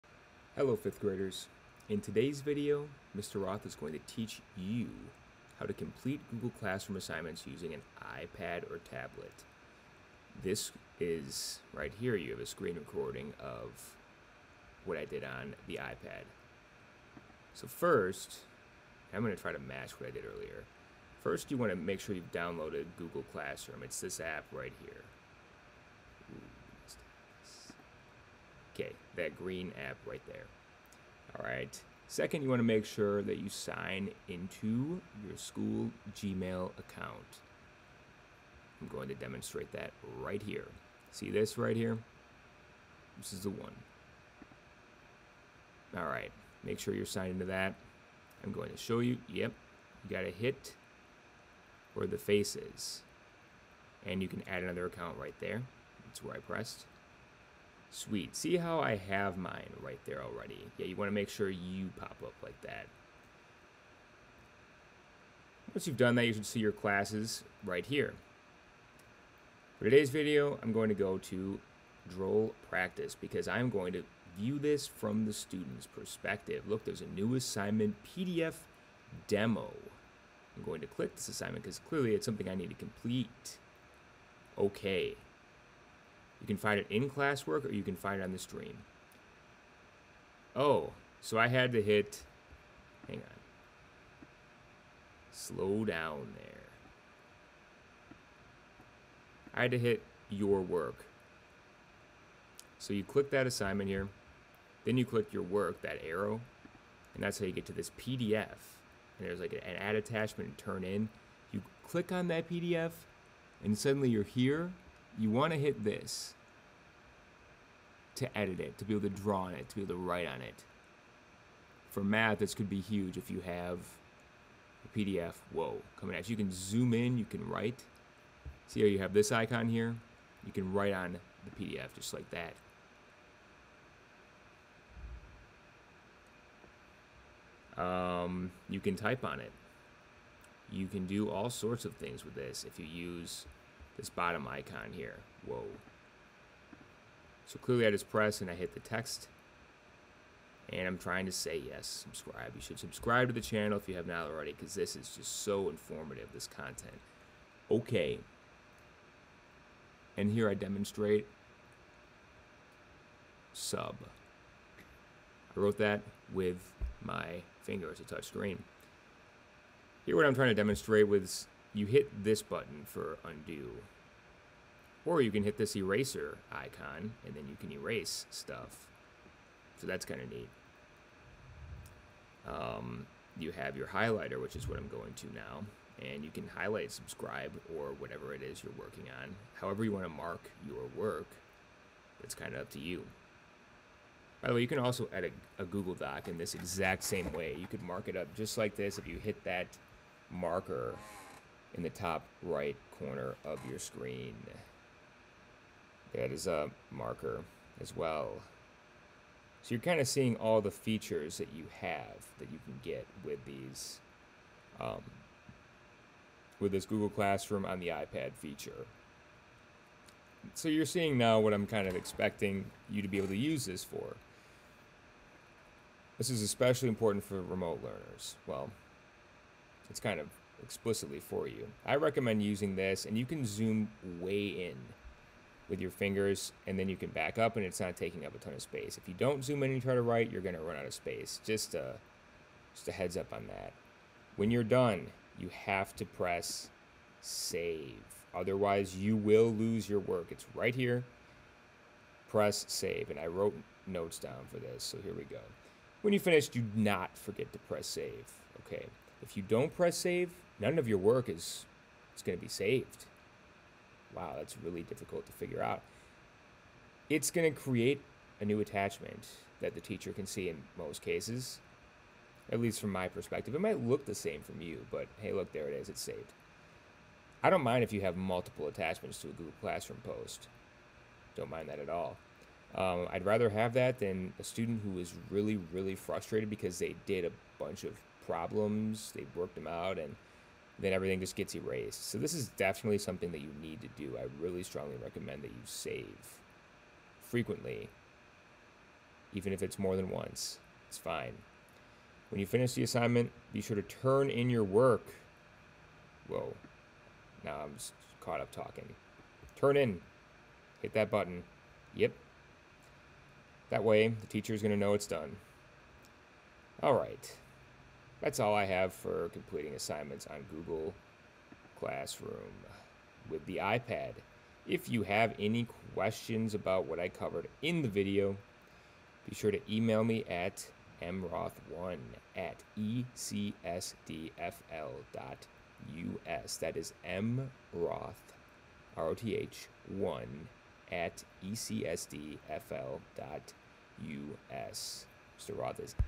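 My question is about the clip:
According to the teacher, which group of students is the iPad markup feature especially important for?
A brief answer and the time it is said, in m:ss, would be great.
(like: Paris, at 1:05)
remote learners, at 3:47.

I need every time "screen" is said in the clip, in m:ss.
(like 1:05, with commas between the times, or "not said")
0:12, 2:48, 3:23.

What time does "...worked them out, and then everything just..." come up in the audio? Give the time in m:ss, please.
4:49.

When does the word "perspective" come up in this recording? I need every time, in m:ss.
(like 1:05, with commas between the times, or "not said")
1:15, 4:33.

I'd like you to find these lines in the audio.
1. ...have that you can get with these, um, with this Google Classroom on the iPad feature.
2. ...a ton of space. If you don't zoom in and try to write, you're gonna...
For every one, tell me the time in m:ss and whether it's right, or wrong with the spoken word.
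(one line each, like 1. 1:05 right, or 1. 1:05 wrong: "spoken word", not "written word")
1. 3:31 right
2. 3:58 right.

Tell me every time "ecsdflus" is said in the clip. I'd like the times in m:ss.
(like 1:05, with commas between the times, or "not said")
5:32, 5:41.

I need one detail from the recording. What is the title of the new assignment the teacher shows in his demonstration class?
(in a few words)
PDF demo.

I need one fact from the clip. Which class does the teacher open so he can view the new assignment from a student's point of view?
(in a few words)
Droll Practice.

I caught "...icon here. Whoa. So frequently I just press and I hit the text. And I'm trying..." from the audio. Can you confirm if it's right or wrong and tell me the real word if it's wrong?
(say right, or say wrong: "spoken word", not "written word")
wrong: "clearly", not "frequently".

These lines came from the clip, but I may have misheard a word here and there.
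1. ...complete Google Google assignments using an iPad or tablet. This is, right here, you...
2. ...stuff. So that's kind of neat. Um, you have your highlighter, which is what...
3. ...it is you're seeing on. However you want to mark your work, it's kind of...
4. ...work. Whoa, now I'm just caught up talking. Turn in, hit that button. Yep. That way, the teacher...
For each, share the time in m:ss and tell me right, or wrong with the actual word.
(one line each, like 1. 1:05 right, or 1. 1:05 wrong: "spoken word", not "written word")
1. 0:05 wrong: "Classroom", not "Google"
2. 2:58 right
3. 3:08 wrong: "working", not "seeing"
4. 5:04 right.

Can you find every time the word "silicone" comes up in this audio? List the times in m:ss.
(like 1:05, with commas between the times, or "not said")
not said.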